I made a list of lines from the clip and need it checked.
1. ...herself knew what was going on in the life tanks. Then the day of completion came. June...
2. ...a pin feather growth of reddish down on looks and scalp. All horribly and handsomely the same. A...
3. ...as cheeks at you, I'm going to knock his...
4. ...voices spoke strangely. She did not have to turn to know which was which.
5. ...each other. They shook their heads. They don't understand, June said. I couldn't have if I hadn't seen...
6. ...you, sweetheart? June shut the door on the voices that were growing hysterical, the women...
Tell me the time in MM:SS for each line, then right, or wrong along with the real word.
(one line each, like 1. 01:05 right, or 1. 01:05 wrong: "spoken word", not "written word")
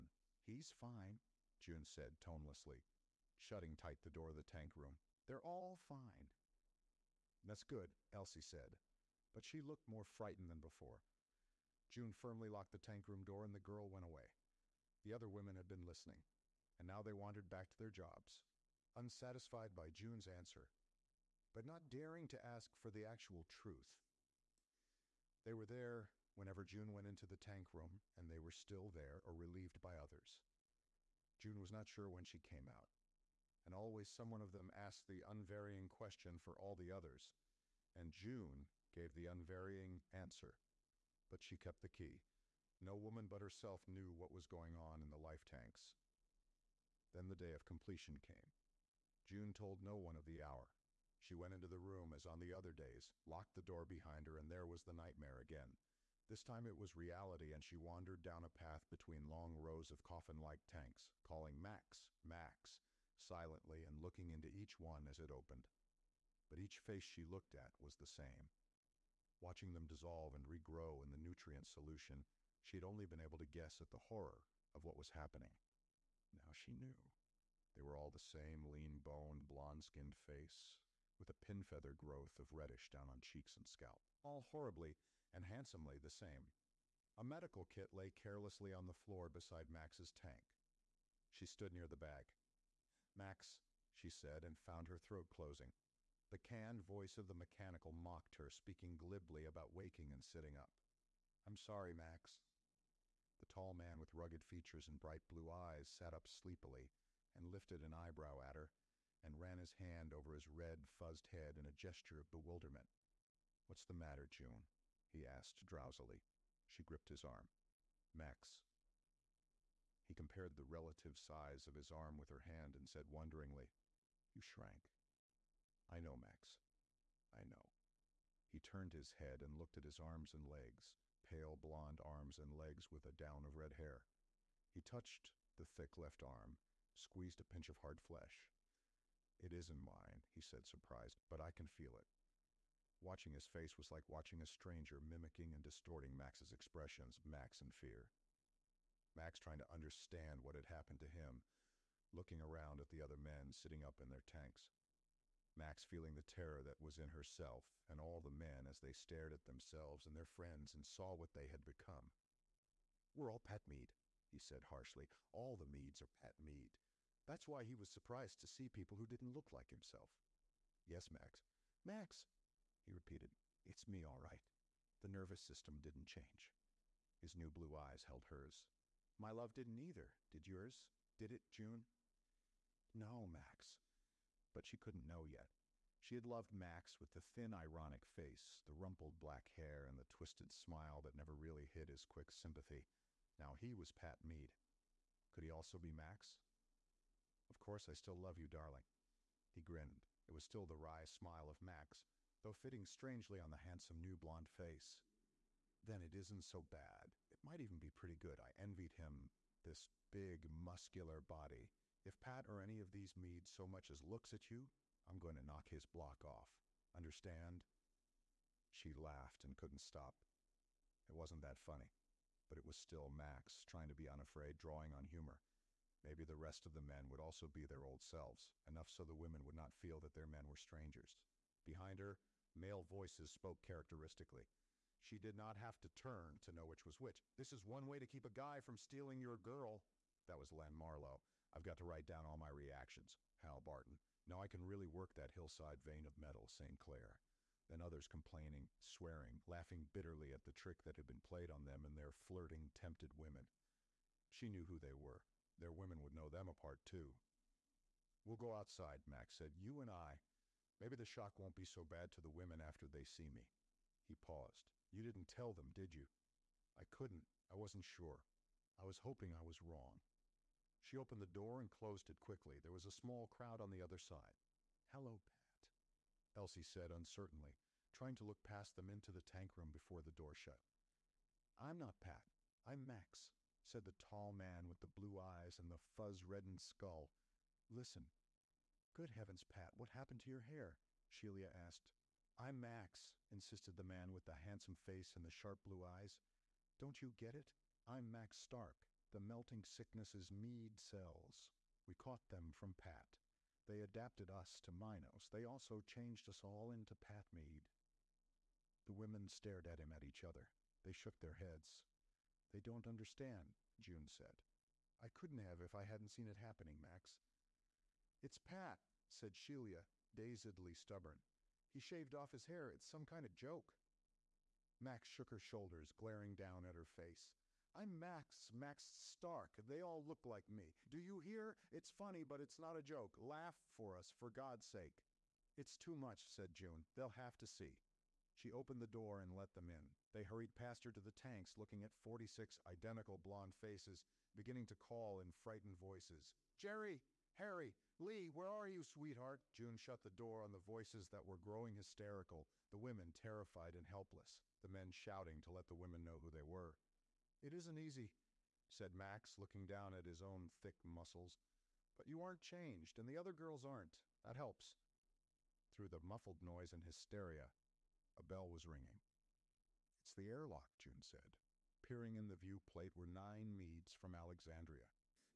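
1. 00:43 right
2. 01:21 wrong: "cheeks", not "looks"
3. 03:33 wrong: "looks", not "cheeks"
4. 03:52 wrong: "characteristically", not "strangely"
5. 05:10 right
6. 05:48 right.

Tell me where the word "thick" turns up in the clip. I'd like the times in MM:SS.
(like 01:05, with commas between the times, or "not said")
02:15, 06:00.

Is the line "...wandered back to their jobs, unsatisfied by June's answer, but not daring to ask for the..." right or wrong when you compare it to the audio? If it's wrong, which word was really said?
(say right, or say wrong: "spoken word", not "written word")
right.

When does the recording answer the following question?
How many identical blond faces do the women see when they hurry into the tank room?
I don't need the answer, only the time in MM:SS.
05:41.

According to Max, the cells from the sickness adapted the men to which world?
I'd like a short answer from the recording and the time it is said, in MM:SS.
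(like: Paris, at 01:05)
Minos, at 05:04.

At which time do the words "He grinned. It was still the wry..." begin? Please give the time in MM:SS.
03:19.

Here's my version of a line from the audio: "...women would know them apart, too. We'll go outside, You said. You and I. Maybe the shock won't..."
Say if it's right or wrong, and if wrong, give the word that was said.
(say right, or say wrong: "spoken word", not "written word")
wrong: "Max", not "You".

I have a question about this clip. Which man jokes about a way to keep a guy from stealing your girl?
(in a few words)
Len Marlowe.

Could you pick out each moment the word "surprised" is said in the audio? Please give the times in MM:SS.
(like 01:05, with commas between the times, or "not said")
02:20, 02:47.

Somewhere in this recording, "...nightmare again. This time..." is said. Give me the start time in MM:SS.
00:54.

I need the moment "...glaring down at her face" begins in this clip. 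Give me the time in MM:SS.
05:25.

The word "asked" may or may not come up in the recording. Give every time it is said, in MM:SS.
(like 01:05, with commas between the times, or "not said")
00:34, 01:55, 04:51.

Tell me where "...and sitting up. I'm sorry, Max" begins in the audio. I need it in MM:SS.
01:40.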